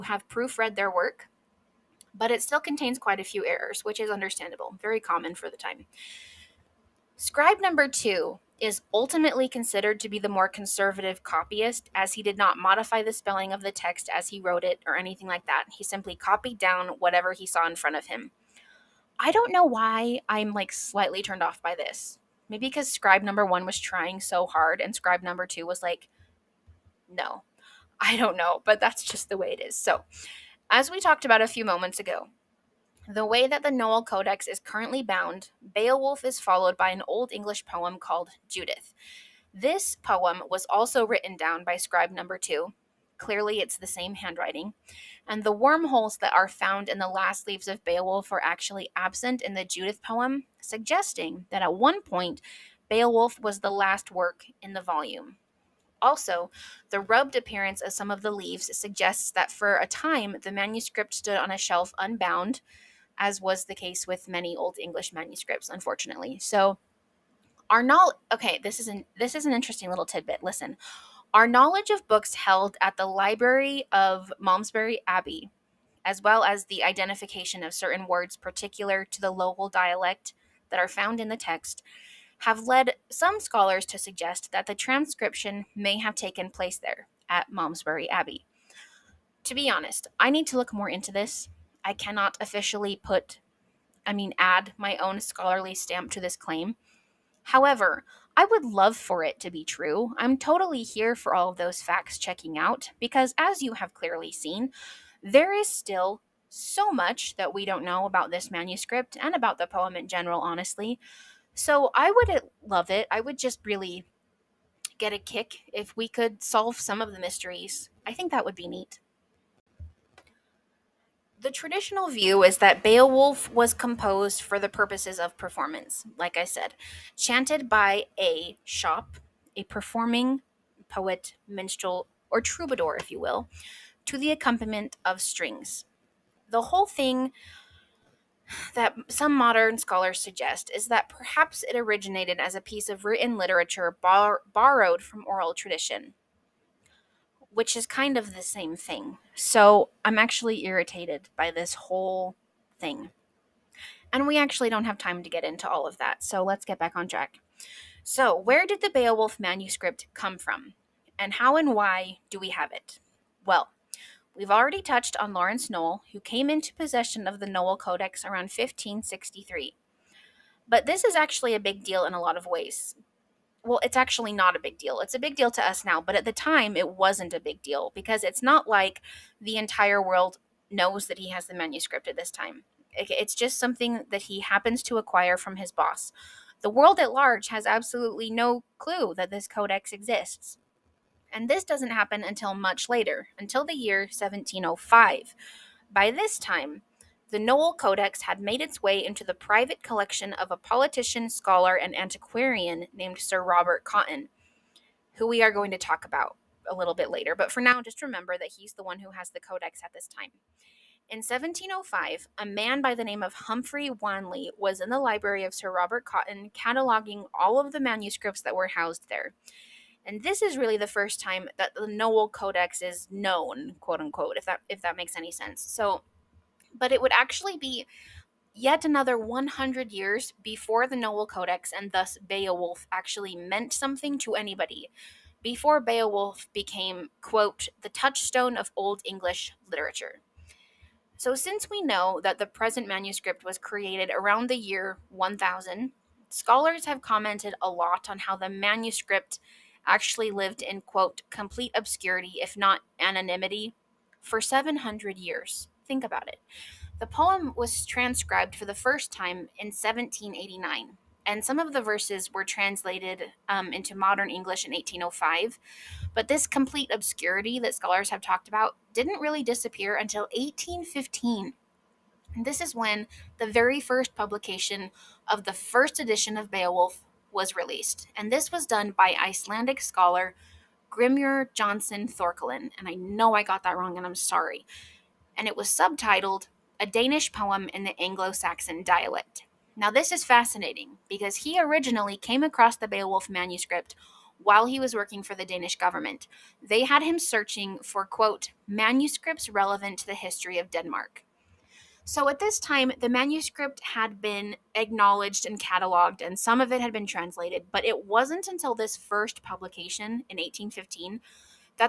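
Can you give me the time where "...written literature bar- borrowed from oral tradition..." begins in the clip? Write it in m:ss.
2:23.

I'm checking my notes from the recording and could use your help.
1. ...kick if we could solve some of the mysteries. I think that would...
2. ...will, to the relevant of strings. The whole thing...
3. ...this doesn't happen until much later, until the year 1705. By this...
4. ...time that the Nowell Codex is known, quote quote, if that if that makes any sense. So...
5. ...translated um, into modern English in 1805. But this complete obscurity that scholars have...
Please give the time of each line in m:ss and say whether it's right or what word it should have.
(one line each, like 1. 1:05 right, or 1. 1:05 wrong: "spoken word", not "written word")
1. 1:55 right
2. 2:13 wrong: "accompaniment", not "relevant"
3. 3:11 right
4. 3:41 wrong: "unquote", not "quote"
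5. 4:22 right.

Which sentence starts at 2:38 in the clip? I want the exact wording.
So, where did the Beowulf manuscript come from?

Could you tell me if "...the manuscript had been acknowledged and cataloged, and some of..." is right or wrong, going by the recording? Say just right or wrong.
right.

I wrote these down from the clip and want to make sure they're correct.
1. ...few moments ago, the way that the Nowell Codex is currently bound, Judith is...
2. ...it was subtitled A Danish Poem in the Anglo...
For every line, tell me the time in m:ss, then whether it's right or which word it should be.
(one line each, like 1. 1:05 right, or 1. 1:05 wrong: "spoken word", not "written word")
1. 0:31 wrong: "Beowulf", not "Judith"
2. 4:45 right.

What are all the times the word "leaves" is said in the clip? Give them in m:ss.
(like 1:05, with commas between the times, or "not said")
0:47, 0:58.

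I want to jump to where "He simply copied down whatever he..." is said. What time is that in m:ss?
0:15.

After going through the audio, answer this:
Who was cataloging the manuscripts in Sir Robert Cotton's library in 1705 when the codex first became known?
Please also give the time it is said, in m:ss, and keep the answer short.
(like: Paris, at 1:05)
Humphrey Wanley, at 3:33.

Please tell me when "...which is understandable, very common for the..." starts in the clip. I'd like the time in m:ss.
0:03.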